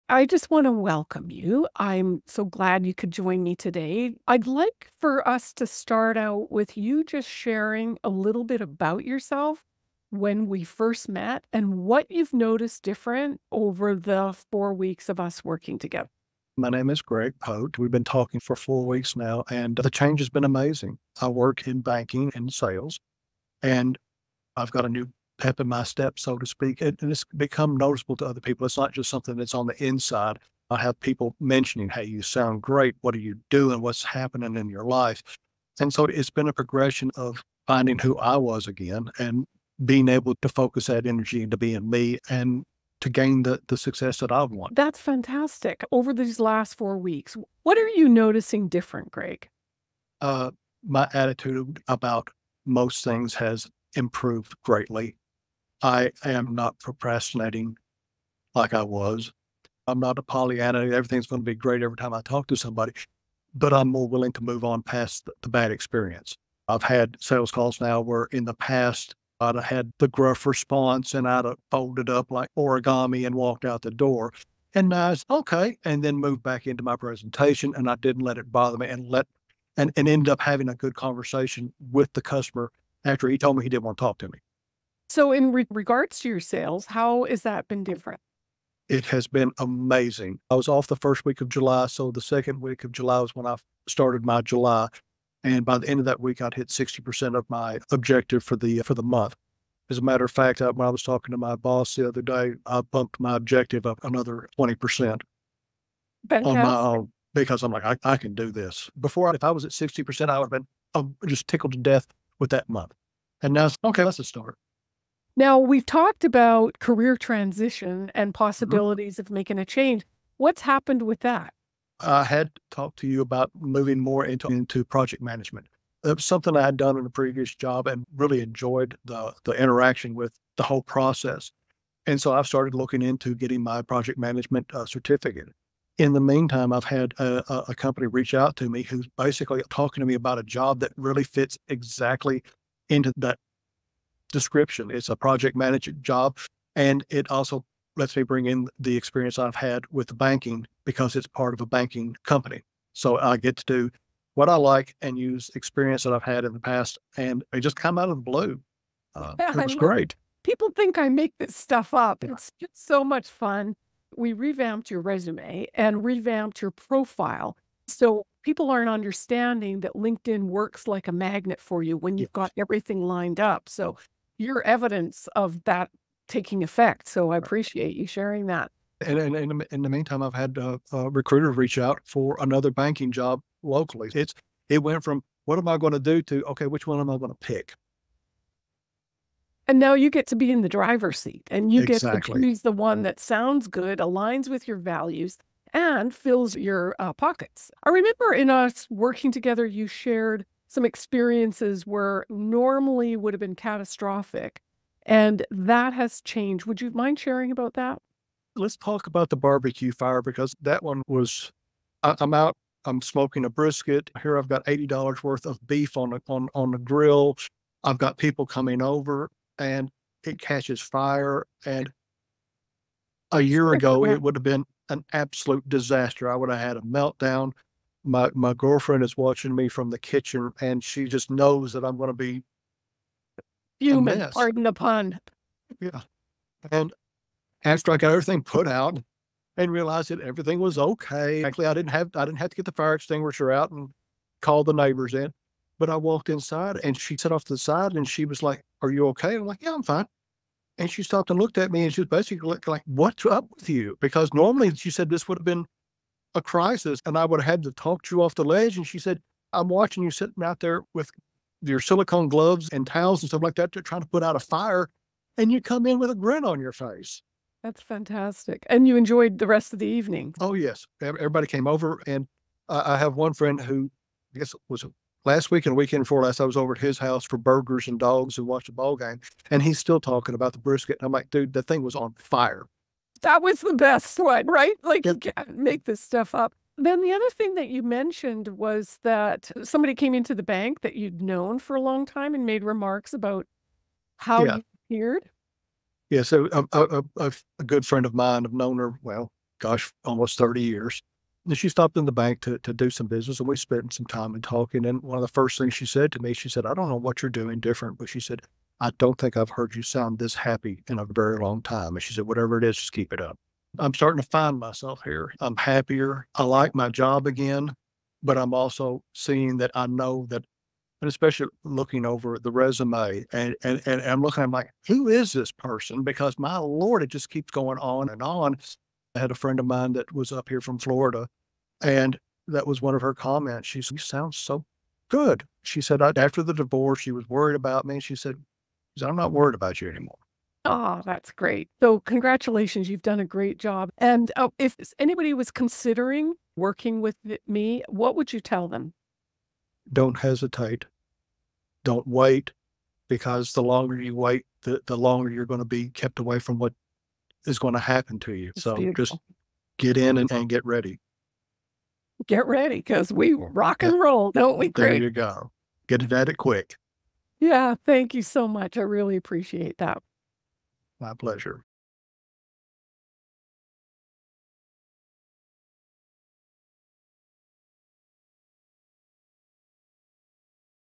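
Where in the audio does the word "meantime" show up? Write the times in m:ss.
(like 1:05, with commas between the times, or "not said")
2:16, 2:59.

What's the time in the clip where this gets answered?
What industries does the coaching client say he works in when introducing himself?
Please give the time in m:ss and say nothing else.
0:21.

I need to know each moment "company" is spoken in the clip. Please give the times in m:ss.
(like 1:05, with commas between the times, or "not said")
2:17, 2:32.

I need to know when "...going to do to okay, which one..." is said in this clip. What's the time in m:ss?
3:05.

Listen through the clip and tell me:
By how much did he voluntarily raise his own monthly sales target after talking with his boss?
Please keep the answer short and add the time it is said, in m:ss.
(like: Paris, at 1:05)
20%, at 1:44.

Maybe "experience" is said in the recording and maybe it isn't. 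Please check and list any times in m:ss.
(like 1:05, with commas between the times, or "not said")
1:05, 2:28, 2:35, 3:20.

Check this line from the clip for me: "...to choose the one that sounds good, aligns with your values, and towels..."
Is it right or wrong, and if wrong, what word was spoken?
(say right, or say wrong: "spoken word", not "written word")
wrong: "fills", not "towels".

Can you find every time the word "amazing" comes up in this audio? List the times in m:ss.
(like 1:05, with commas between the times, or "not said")
0:20, 1:29.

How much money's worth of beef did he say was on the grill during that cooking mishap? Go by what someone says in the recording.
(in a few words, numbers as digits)
$80.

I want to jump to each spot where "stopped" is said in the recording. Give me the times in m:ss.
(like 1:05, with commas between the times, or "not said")
4:11, 5:01.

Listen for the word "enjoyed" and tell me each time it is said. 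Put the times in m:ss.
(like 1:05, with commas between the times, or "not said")
2:08, 4:28.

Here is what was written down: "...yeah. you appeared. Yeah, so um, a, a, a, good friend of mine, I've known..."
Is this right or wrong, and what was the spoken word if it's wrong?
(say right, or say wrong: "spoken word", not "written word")
right.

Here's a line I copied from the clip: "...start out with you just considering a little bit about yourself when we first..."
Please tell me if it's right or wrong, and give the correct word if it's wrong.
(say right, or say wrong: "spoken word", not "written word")
wrong: "sharing", not "considering".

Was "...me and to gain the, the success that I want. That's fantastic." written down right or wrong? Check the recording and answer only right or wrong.
right.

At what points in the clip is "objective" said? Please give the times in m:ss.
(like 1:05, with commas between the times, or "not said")
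1:37, 1:43.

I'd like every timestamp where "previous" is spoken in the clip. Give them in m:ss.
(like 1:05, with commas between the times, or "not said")
2:07.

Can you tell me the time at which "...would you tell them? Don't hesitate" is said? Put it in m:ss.
5:48.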